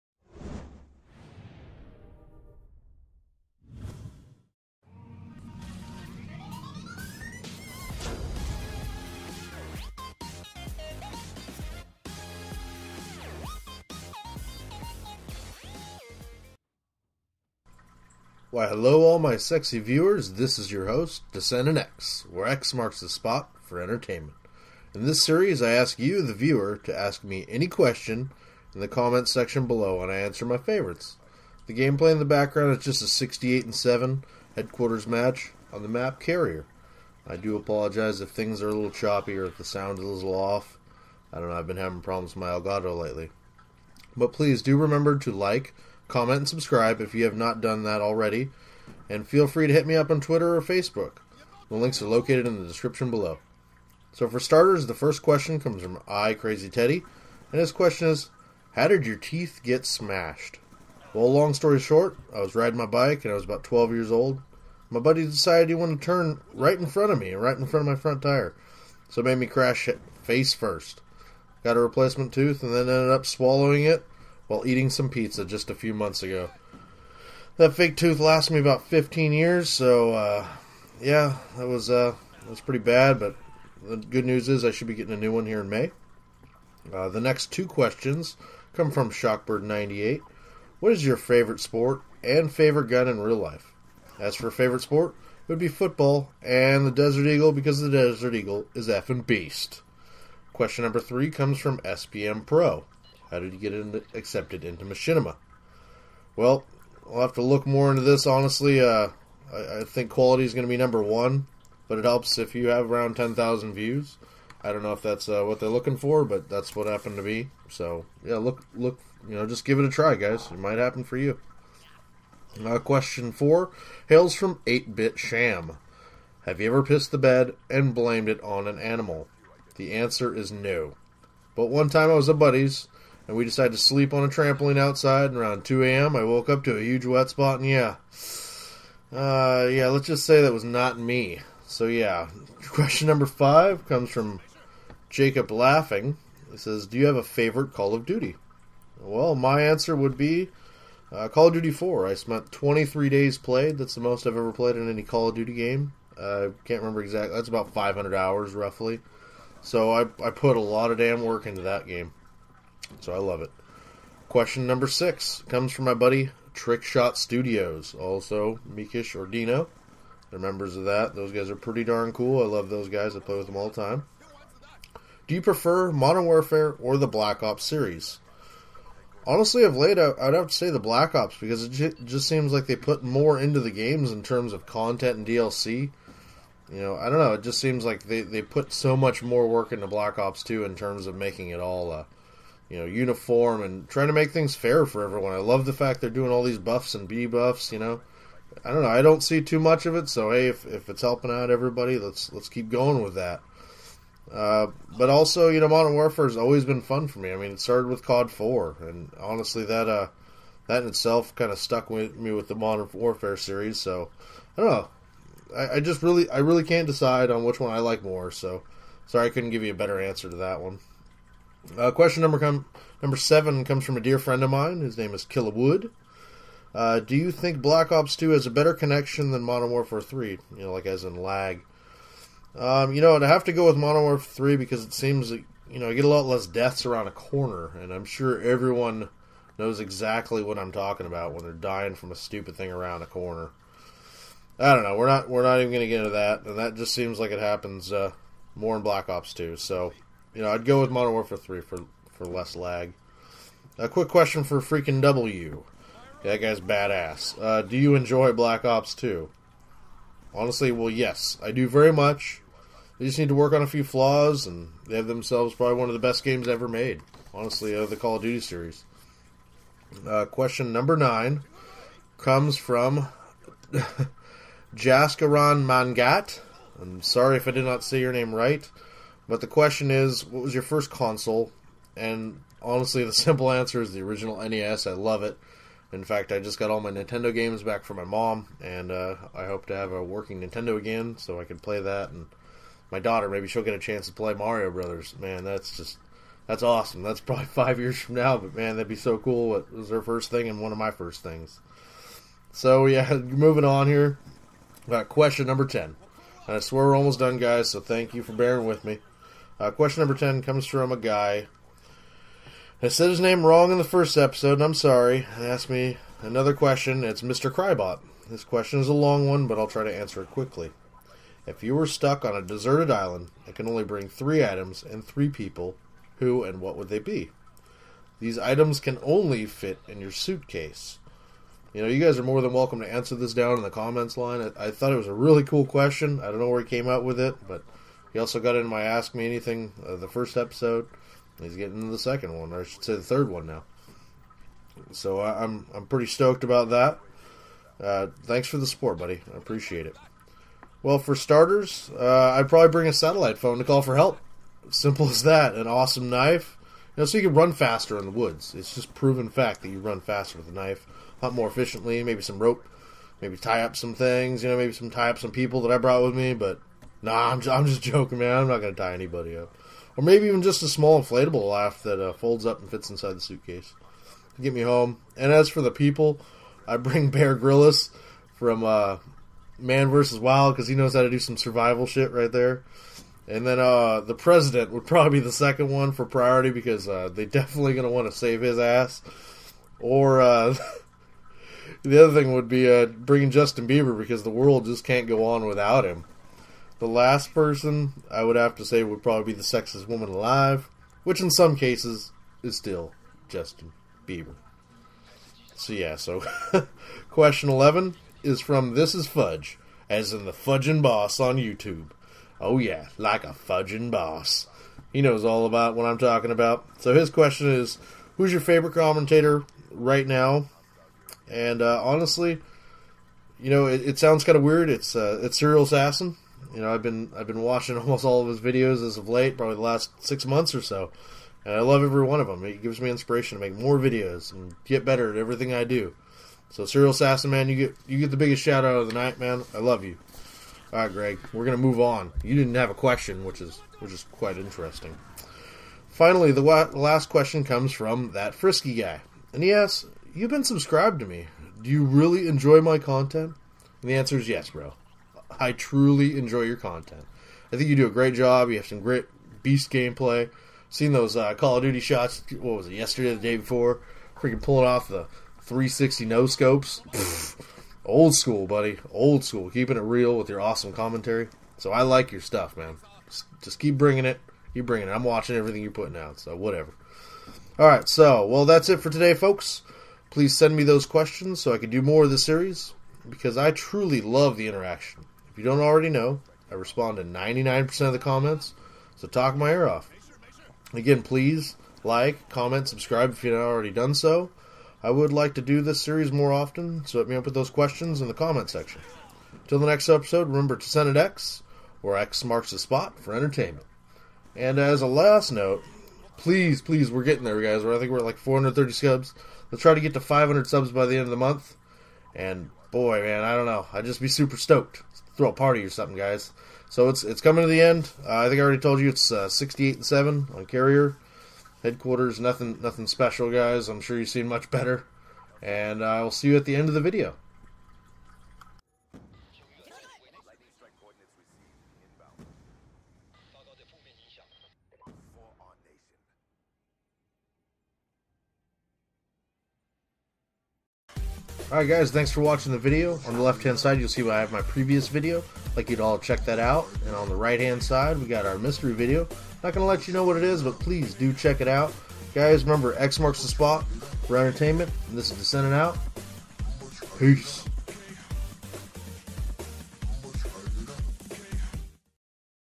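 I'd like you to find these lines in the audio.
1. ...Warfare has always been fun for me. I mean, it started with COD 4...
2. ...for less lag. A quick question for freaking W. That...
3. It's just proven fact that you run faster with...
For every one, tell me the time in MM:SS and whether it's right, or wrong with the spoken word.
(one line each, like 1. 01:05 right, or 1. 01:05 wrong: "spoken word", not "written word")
1. 03:25 right
2. 04:12 right
3. 05:58 right.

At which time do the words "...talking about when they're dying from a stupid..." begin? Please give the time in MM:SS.
04:00.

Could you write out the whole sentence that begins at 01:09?
So it made me crash face first.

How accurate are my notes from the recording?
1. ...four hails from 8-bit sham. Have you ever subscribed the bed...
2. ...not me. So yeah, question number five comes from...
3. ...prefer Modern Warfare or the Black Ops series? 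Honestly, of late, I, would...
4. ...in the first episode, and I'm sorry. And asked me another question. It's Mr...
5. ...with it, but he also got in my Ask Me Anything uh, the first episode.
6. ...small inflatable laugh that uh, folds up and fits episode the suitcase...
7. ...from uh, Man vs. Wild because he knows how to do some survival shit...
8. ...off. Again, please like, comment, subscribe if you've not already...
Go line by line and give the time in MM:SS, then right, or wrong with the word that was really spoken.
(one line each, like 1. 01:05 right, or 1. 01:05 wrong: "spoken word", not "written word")
1. 02:03 wrong: "pissed", not "subscribed"
2. 02:20 right
3. 02:55 right
4. 05:13 right
5. 05:37 right
6. 06:10 wrong: "inside", not "episode"
7. 06:18 right
8. 08:09 right.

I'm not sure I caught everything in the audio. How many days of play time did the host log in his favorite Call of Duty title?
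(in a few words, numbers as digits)
23.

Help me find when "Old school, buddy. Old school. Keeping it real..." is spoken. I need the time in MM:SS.
07:47.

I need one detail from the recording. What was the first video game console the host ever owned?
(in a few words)
original NES.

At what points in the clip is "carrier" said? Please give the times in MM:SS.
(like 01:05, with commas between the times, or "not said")
00:36, 08:40.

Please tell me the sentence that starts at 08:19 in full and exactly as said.
Till the next episode, remember to send it X, where X marks the spot for entertainment.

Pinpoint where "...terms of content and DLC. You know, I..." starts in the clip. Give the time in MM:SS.
03:04.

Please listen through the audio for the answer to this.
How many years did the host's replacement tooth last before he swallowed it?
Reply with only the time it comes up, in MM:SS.
01:18.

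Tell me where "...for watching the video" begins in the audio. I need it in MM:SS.
09:02.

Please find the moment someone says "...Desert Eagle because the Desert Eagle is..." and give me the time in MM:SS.
01:36.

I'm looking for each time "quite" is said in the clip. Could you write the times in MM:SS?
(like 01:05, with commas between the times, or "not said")
07:24.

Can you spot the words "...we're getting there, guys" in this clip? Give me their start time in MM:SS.
08:26.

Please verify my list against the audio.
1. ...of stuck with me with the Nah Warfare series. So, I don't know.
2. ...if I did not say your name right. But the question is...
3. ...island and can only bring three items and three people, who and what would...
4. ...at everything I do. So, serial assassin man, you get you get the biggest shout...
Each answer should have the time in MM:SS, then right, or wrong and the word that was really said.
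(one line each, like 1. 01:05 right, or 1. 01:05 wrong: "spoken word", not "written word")
1. 03:31 wrong: "Modern", not "Nah"
2. 04:37 right
3. 05:22 right
4. 07:15 right.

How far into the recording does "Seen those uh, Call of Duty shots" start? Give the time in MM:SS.
07:40.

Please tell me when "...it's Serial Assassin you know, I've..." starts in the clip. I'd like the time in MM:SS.
07:05.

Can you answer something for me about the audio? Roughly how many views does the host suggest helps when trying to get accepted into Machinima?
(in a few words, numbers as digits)
10,000.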